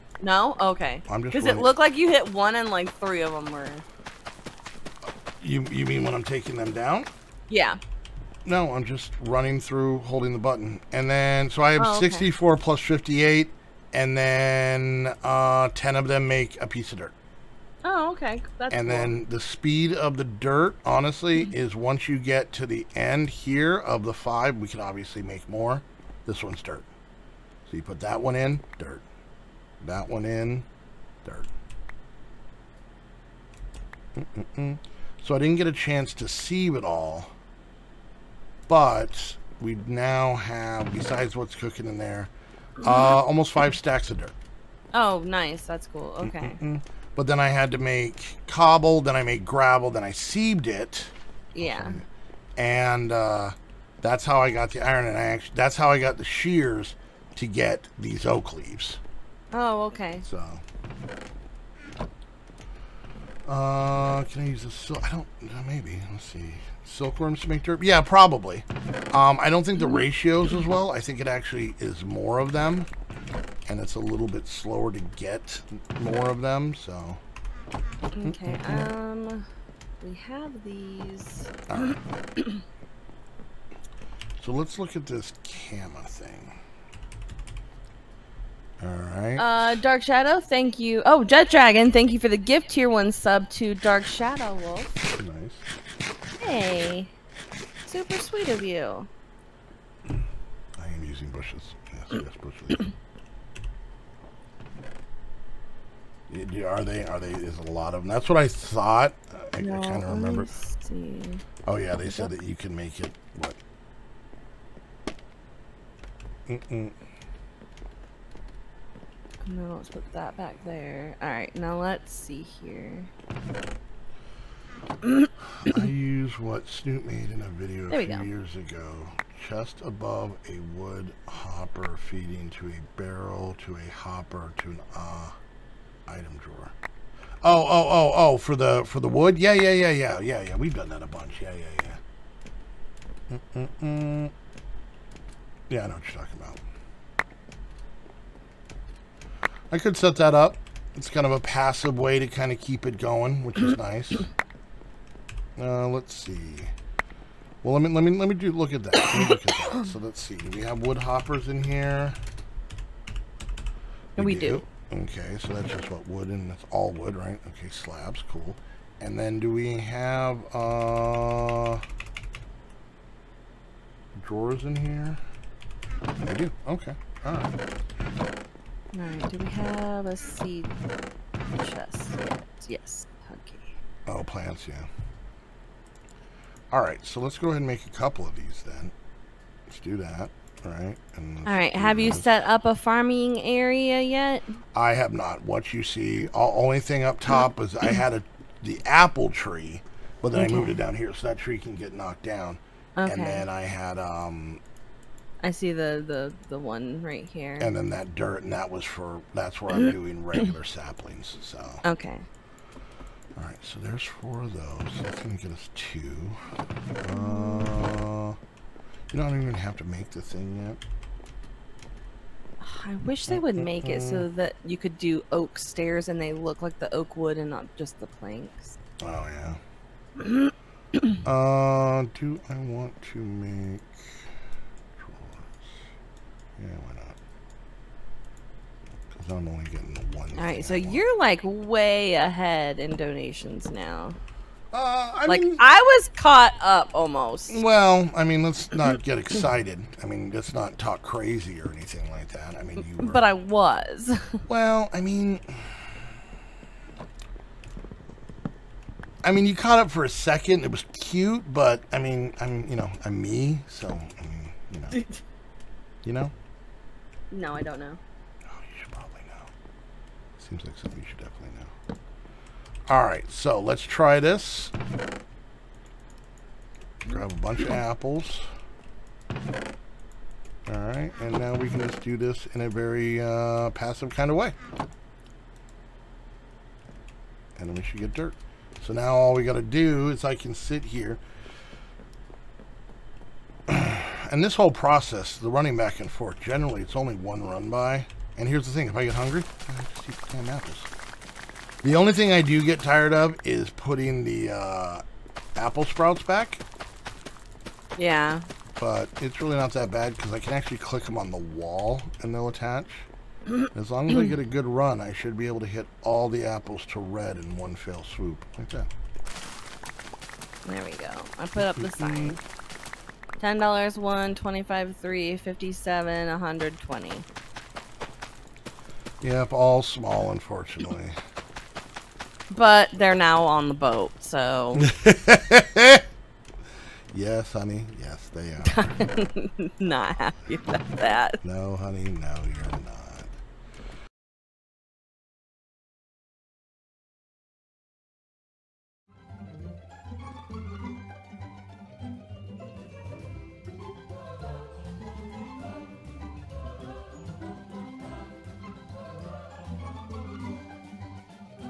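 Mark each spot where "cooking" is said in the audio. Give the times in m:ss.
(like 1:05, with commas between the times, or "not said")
0:41.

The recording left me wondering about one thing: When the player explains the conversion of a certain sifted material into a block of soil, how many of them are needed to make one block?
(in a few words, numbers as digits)
10.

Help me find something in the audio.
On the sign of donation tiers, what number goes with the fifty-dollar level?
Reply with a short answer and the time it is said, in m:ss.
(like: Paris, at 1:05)
7, at 5:25.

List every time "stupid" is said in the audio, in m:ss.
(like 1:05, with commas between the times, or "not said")
not said.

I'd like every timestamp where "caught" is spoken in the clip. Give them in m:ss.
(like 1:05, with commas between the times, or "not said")
4:06, 4:19.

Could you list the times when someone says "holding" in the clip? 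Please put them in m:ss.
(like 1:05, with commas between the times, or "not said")
0:09.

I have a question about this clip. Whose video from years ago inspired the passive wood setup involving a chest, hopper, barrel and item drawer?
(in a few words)
Snoop.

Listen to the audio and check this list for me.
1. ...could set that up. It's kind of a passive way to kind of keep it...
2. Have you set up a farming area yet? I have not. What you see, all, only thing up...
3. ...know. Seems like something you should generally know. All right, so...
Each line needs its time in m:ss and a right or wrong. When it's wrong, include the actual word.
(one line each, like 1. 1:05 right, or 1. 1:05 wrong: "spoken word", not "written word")
1. 2:29 right
2. 3:11 right
3. 4:29 wrong: "definitely", not "generally".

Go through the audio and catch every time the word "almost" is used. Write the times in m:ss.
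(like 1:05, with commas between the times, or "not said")
0:43, 4:06.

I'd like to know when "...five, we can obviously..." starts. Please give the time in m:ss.
0:24.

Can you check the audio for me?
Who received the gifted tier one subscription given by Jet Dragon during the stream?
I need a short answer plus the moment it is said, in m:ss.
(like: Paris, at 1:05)
Dark Shadow Wolf, at 1:33.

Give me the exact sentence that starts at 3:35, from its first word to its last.
That's going to get us two.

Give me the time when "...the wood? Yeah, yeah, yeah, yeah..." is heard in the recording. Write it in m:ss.
2:18.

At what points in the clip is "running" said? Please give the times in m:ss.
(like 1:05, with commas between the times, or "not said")
0:09, 4:55.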